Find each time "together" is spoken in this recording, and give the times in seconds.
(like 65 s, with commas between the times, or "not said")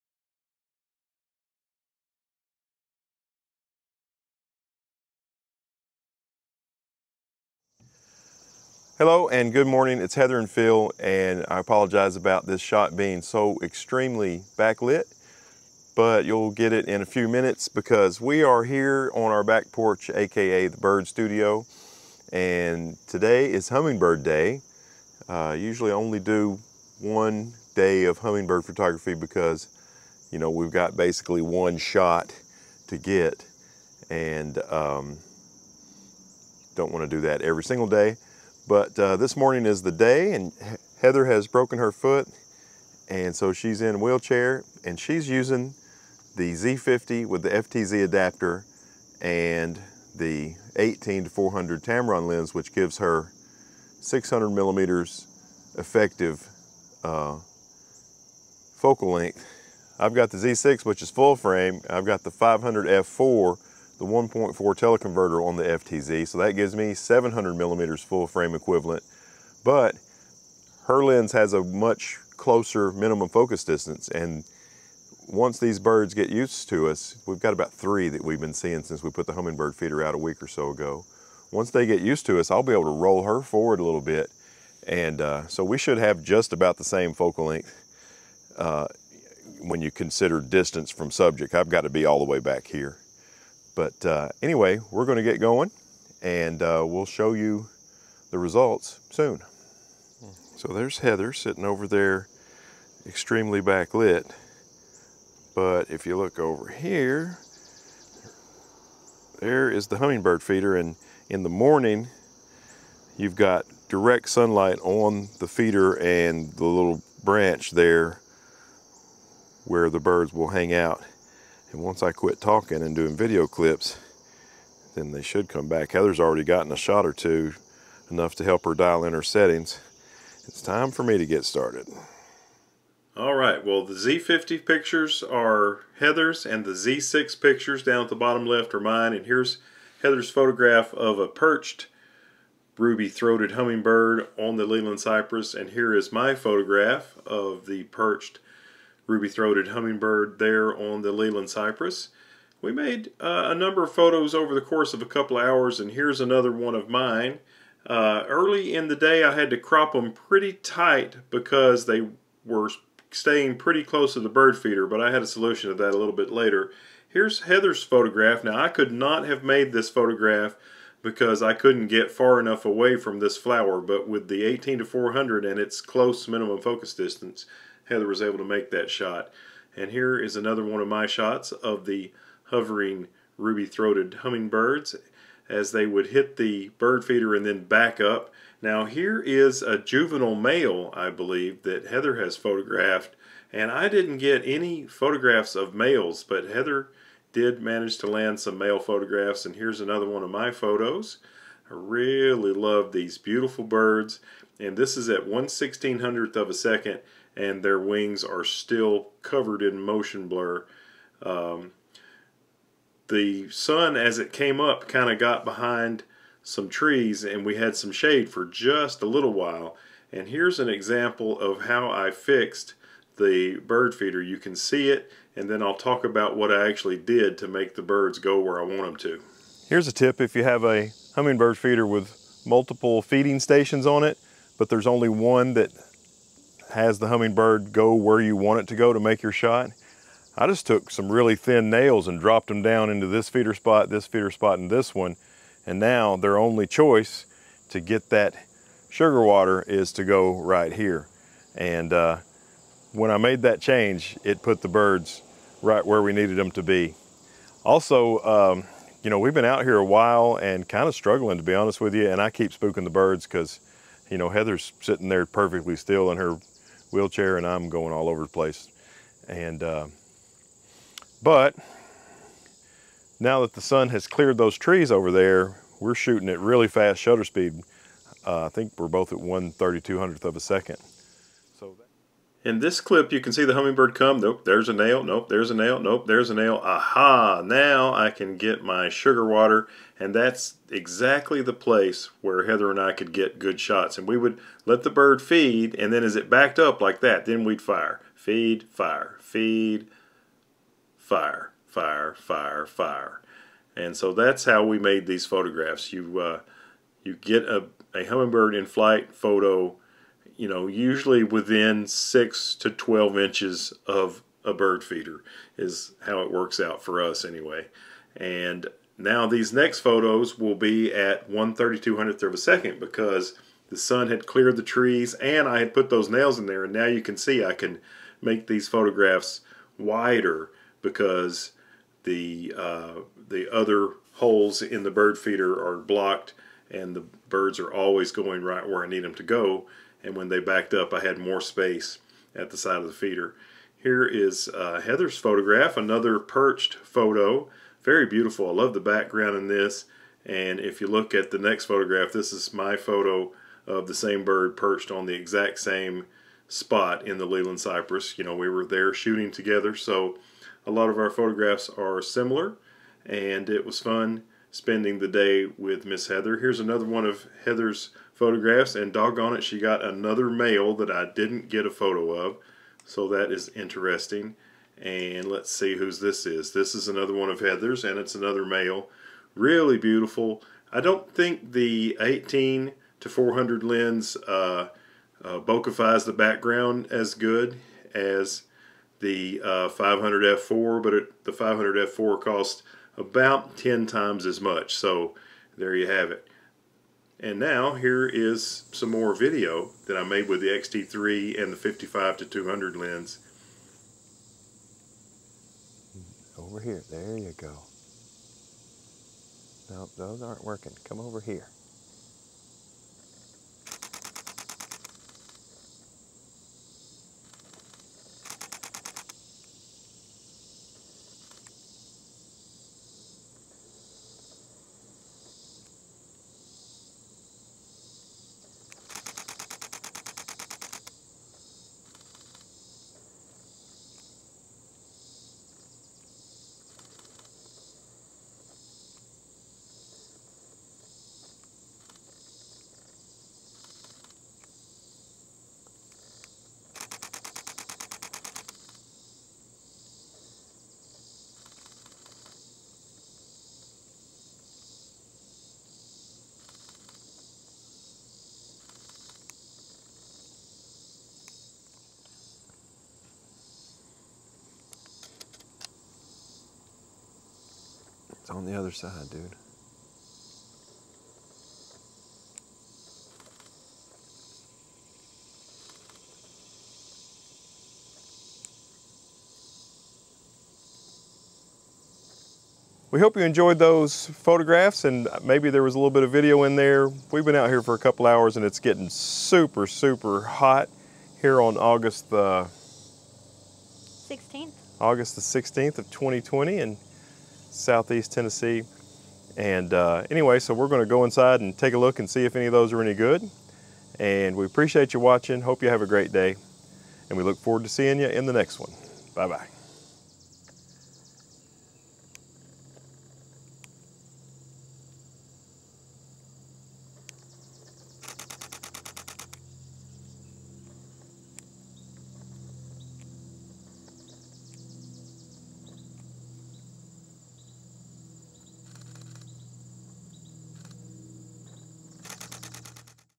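359 s.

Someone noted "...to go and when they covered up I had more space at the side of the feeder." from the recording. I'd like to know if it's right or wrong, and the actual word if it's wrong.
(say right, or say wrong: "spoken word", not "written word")
wrong: "backed", not "covered".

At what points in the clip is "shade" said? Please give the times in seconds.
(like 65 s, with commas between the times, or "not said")
217 s.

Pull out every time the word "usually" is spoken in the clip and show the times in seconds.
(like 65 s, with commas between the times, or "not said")
25 s, 310 s.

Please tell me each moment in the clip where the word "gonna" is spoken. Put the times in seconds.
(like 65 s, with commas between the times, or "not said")
95 s, 500 s.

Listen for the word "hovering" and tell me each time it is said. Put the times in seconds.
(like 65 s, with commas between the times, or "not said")
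182 s.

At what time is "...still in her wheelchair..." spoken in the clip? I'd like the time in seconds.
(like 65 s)
265 s.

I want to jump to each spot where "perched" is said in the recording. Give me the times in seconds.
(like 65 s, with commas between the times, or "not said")
141 s, 147 s, 346 s, 354 s.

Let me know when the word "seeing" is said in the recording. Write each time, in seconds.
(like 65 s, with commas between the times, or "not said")
78 s, 507 s.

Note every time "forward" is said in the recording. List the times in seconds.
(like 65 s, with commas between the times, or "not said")
83 s, 507 s.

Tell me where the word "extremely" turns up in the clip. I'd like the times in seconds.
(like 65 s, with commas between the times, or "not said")
13 s, 103 s.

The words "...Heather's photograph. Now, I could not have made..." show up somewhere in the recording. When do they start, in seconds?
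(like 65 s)
167 s.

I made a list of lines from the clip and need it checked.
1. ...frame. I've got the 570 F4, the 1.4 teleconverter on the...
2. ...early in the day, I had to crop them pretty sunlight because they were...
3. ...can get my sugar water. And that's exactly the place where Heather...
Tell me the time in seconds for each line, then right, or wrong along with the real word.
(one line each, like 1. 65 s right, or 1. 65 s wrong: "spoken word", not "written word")
1. 61 s wrong: "500", not "570"
2. 158 s wrong: "tight", not "sunlight"
3. 288 s right.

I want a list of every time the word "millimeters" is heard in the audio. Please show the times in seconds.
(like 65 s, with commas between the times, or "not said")
54 s, 67 s.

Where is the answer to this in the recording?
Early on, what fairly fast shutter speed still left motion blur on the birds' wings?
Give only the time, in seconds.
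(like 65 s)
205 s.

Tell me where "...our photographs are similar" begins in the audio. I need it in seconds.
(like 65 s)
360 s.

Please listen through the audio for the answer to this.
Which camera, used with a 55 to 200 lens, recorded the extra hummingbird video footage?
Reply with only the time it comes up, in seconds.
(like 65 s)
400 s.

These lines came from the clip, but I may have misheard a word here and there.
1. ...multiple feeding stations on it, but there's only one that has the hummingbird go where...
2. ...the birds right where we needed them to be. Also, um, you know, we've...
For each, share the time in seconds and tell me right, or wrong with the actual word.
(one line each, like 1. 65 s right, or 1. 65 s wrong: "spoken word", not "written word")
1. 232 s right
2. 254 s right.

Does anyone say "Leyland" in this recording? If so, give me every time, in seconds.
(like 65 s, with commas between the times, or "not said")
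144 s, 151 s, 357 s.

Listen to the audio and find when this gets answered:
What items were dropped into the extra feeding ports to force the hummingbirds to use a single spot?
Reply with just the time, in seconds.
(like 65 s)
241 s.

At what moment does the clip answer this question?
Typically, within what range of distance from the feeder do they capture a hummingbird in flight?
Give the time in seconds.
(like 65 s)
311 s.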